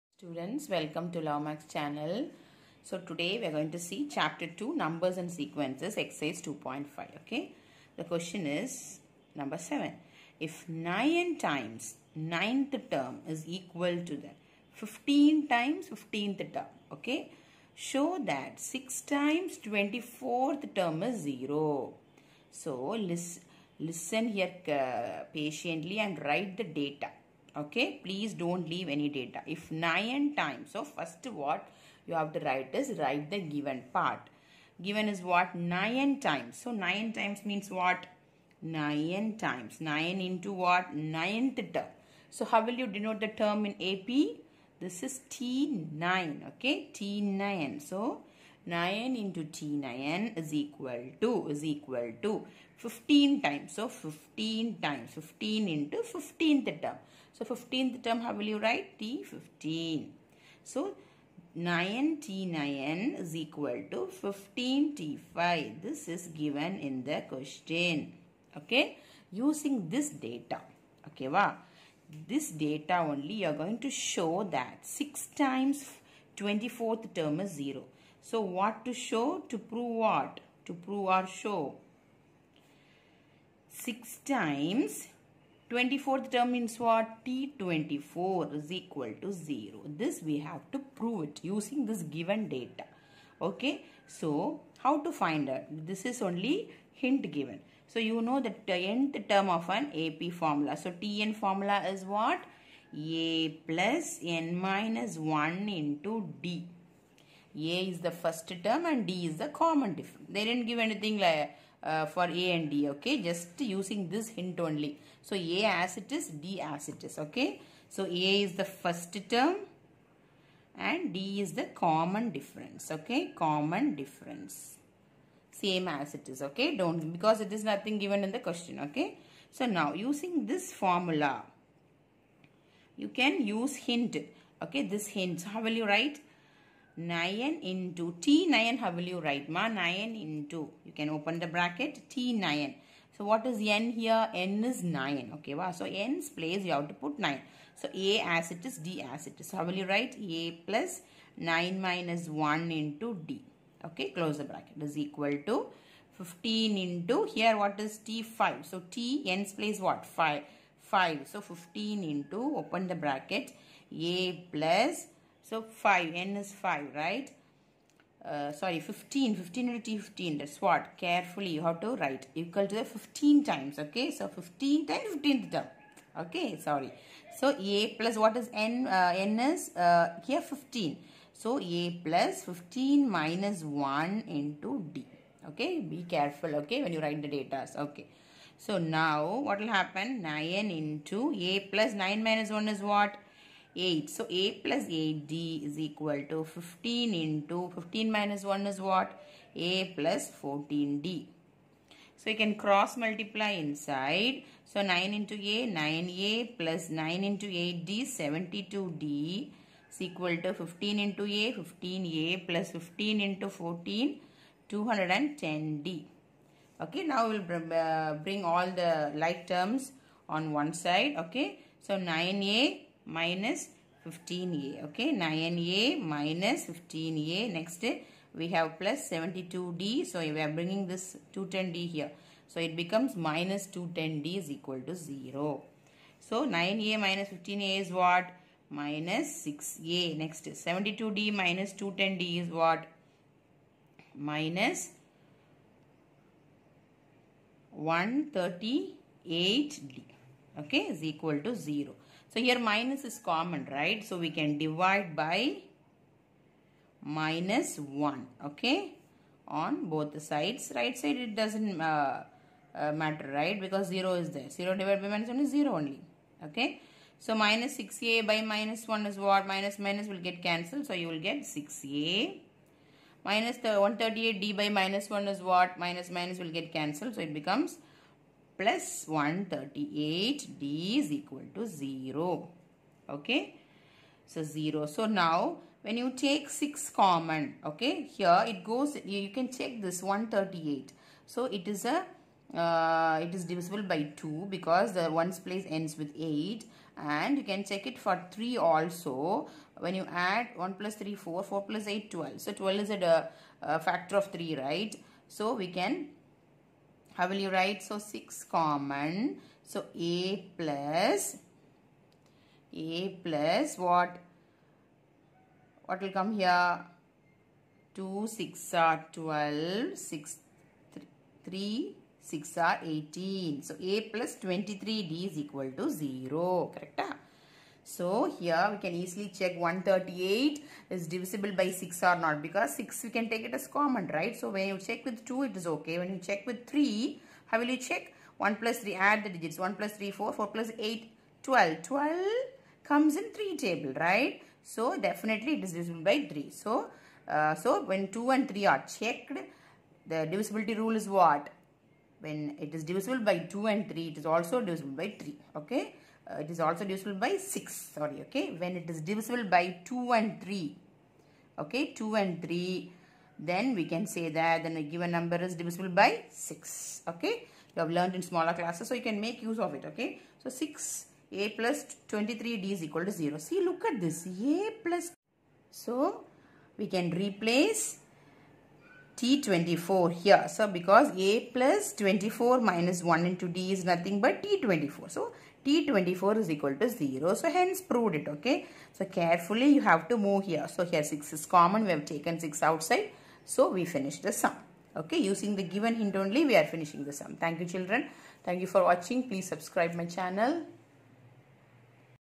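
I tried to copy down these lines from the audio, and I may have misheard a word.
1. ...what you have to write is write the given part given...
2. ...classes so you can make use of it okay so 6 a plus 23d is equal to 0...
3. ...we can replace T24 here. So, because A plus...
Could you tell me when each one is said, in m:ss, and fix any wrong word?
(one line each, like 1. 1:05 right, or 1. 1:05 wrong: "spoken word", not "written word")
1. 0:31 right
2. 6:08 right
3. 6:16 right.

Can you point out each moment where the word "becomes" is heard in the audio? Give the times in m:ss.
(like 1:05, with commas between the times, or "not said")
3:52, 4:37.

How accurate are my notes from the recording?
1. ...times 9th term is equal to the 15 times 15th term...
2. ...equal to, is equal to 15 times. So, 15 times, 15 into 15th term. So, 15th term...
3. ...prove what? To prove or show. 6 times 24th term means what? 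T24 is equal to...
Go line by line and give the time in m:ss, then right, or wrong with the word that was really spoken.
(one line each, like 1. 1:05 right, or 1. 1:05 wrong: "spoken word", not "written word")
1. 0:11 right
2. 0:50 right
3. 1:19 right.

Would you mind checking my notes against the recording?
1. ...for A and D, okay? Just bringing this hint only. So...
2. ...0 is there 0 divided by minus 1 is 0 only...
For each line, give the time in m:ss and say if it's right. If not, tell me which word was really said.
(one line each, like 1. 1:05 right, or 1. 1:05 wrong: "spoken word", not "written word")
1. 1:52 wrong: "using", not "bringing"
2. 4:23 right.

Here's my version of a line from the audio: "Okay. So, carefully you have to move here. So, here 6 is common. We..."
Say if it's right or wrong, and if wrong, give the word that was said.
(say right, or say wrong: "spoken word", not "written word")
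right.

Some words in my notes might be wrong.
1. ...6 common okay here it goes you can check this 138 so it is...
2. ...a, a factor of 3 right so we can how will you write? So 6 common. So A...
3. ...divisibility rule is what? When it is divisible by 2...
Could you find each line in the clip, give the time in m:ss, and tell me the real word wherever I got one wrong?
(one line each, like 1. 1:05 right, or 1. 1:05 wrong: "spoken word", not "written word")
1. 4:46 right
2. 5:03 right
3. 5:50 right.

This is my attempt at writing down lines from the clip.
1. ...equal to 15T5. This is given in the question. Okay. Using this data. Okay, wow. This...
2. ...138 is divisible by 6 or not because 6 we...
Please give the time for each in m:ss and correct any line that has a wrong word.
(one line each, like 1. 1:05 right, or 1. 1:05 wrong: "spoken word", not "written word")
1. 1:03 right
2. 5:29 right.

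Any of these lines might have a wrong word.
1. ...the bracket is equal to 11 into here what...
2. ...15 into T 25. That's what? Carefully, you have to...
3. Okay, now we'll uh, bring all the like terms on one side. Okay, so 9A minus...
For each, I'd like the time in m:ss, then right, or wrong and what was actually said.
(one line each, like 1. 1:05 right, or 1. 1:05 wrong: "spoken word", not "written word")
1. 2:34 wrong: "15", not "11"
2. 2:49 wrong: "15", not "25"
3. 3:36 right.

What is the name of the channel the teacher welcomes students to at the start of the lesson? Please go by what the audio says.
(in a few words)
Lawmax.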